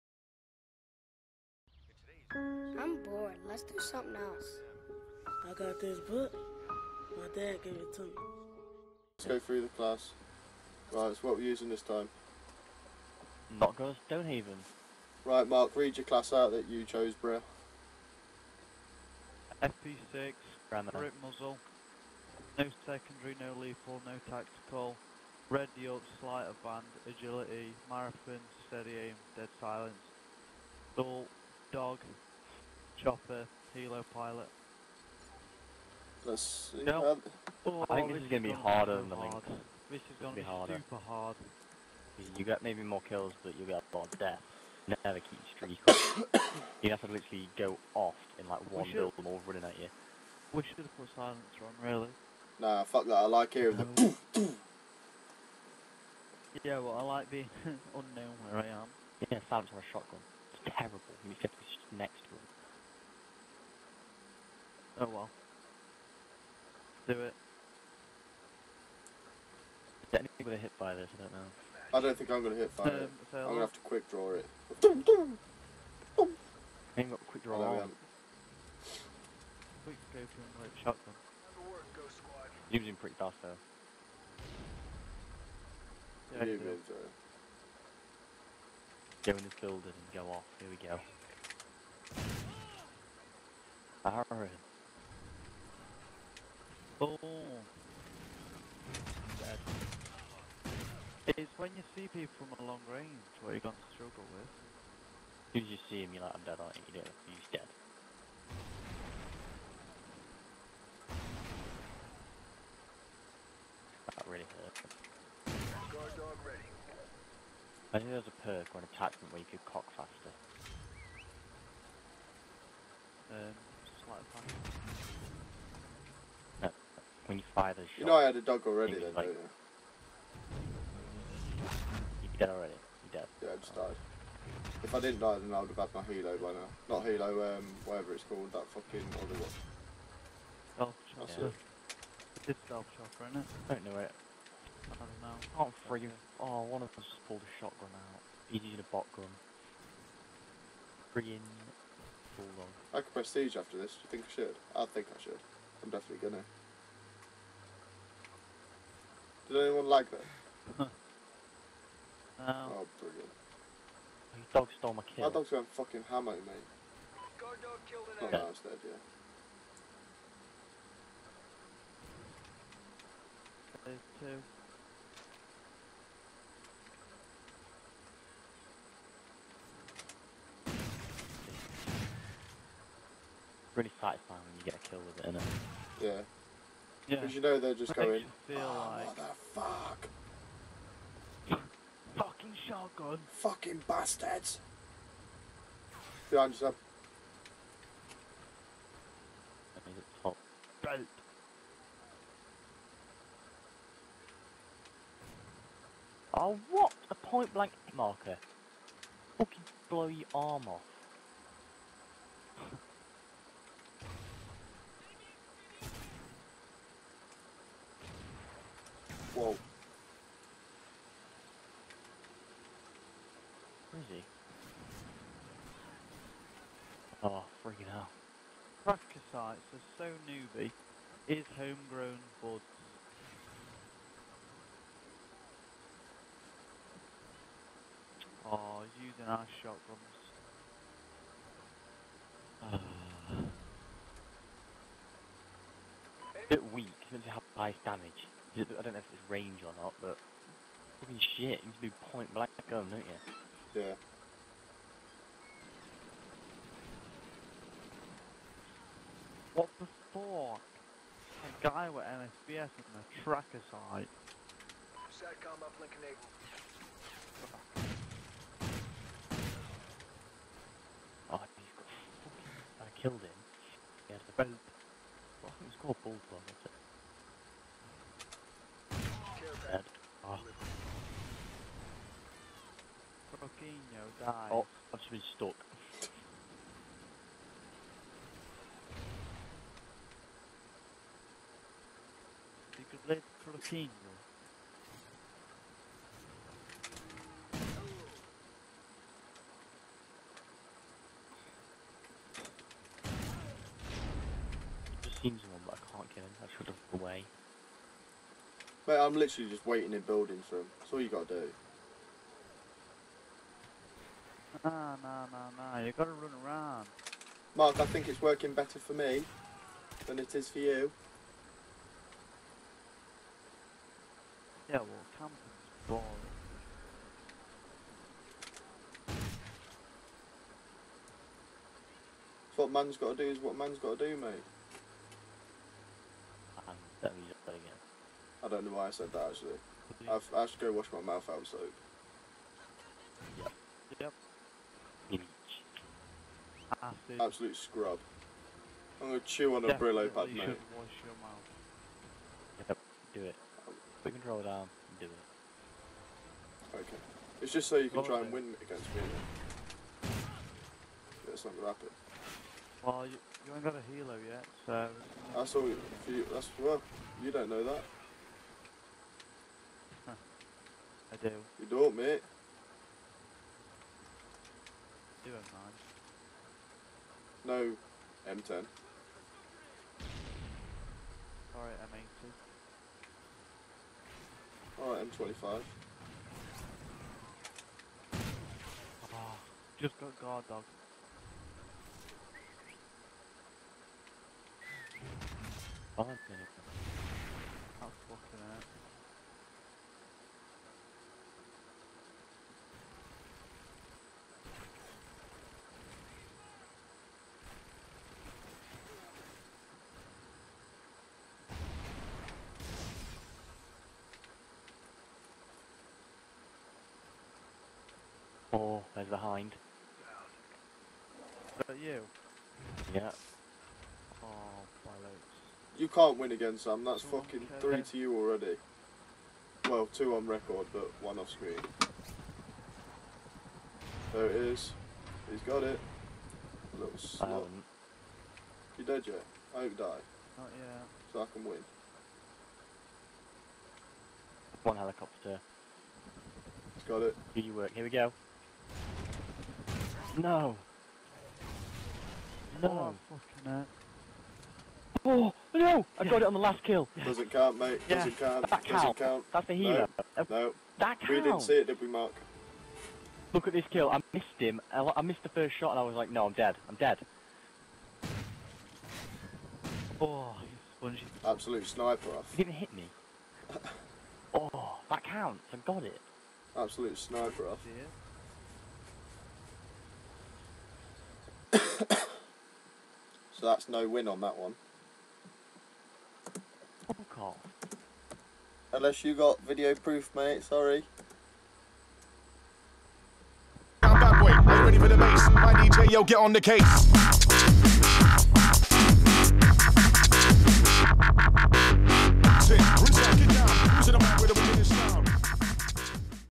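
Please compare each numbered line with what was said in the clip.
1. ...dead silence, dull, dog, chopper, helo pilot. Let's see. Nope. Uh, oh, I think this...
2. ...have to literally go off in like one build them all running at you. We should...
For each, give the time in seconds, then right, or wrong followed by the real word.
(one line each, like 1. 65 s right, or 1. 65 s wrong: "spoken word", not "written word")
1. 29 s right
2. 46 s right.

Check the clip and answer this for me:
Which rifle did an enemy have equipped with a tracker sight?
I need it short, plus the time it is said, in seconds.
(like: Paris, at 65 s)
MSBS, at 262 s.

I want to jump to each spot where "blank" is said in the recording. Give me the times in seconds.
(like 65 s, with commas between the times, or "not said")
207 s, 252 s.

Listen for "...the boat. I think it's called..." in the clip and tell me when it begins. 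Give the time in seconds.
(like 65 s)
274 s.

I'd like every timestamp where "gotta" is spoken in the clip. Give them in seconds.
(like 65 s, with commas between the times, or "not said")
311 s, 315 s.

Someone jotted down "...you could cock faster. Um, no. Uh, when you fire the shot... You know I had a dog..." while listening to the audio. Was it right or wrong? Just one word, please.
right.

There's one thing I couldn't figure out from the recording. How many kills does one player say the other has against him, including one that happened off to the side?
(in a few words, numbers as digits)
3.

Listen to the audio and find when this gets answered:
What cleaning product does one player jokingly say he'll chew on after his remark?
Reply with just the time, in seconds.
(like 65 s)
349 s.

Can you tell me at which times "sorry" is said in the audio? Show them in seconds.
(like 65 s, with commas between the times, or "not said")
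86 s, 490 s.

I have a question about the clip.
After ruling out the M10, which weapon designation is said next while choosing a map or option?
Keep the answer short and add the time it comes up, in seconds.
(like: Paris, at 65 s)
M80, at 381 s.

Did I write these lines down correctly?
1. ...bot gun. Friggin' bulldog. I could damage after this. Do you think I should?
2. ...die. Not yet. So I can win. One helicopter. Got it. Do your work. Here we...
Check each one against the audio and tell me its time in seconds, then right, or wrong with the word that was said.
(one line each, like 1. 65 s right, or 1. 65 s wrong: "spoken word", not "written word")
1. 148 s wrong: "prestige", not "damage"
2. 439 s right.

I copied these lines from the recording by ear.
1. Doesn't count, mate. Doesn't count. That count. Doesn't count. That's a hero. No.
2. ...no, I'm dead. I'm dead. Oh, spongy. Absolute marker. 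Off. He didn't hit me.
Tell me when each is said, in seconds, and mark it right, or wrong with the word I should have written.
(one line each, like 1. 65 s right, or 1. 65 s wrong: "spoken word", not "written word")
1. 457 s right
2. 466 s wrong: "sniper", not "marker".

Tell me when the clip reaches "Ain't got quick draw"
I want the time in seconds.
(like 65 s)
76 s.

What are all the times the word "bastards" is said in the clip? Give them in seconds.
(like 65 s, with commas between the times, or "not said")
193 s.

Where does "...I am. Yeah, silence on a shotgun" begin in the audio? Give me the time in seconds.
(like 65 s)
58 s.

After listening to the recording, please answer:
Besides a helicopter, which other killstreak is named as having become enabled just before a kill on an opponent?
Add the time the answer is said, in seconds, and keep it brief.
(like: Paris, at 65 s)
Satcom, at 265 s.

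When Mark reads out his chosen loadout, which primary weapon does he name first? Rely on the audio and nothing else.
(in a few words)
FP6.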